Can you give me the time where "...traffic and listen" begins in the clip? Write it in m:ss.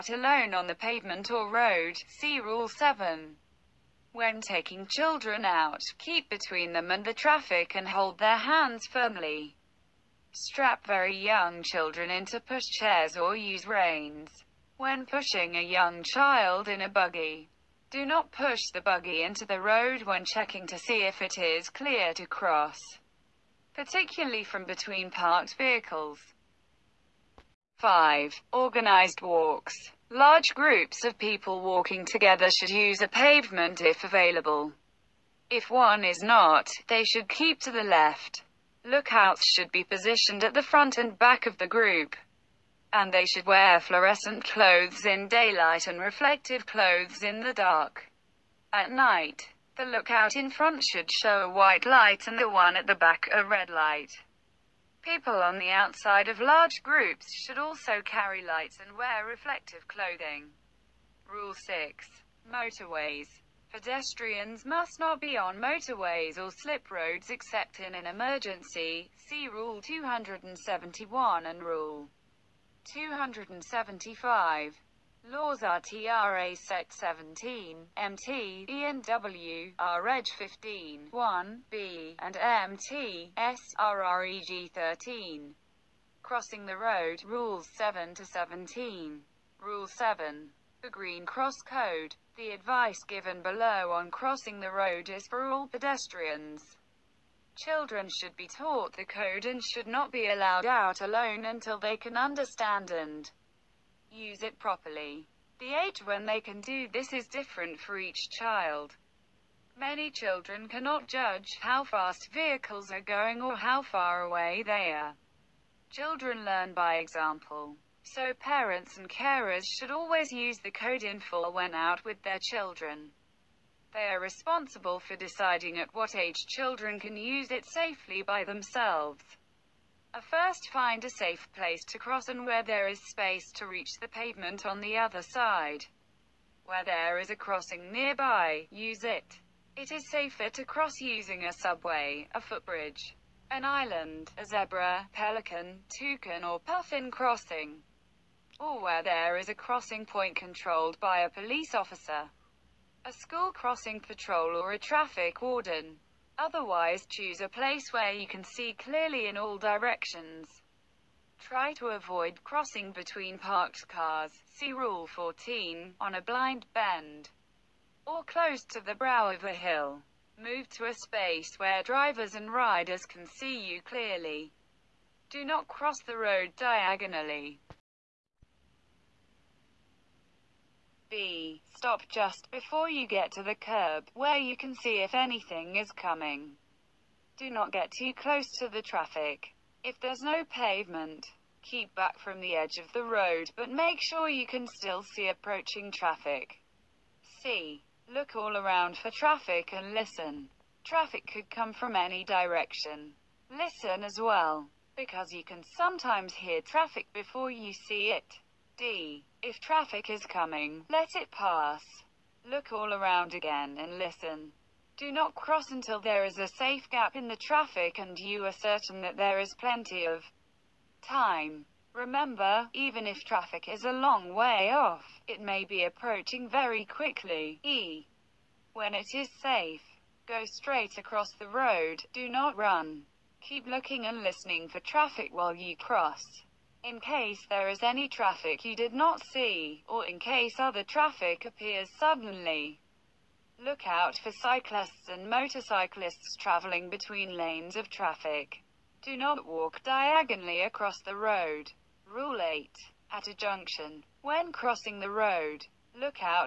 3:19.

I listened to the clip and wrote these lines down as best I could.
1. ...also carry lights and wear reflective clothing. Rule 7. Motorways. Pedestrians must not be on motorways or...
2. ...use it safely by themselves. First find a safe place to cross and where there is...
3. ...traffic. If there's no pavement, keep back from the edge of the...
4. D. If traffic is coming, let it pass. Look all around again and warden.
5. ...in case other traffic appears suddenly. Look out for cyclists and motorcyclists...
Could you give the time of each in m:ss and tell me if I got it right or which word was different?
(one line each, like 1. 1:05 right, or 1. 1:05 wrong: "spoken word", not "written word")
1. 0:57 wrong: "6", not "7"
2. 2:07 right
3. 3:08 right
4. 3:28 wrong: "listen", not "warden"
5. 4:00 right.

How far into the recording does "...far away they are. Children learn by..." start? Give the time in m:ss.
1:53.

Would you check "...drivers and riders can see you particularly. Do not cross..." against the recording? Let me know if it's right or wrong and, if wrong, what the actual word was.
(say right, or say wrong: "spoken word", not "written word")
wrong: "clearly", not "particularly".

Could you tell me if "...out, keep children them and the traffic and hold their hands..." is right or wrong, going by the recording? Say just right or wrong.
wrong.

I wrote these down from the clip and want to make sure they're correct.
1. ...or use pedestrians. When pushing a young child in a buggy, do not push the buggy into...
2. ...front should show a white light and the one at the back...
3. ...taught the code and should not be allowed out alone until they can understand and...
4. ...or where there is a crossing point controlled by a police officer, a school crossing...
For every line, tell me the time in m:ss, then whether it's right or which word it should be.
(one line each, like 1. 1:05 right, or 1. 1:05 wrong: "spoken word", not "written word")
1. 0:13 wrong: "reins", not "pedestrians"
2. 0:50 right
3. 1:38 right
4. 2:28 right.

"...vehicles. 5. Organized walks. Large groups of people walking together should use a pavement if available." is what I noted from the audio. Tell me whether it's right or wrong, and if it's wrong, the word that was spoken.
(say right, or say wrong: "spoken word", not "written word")
right.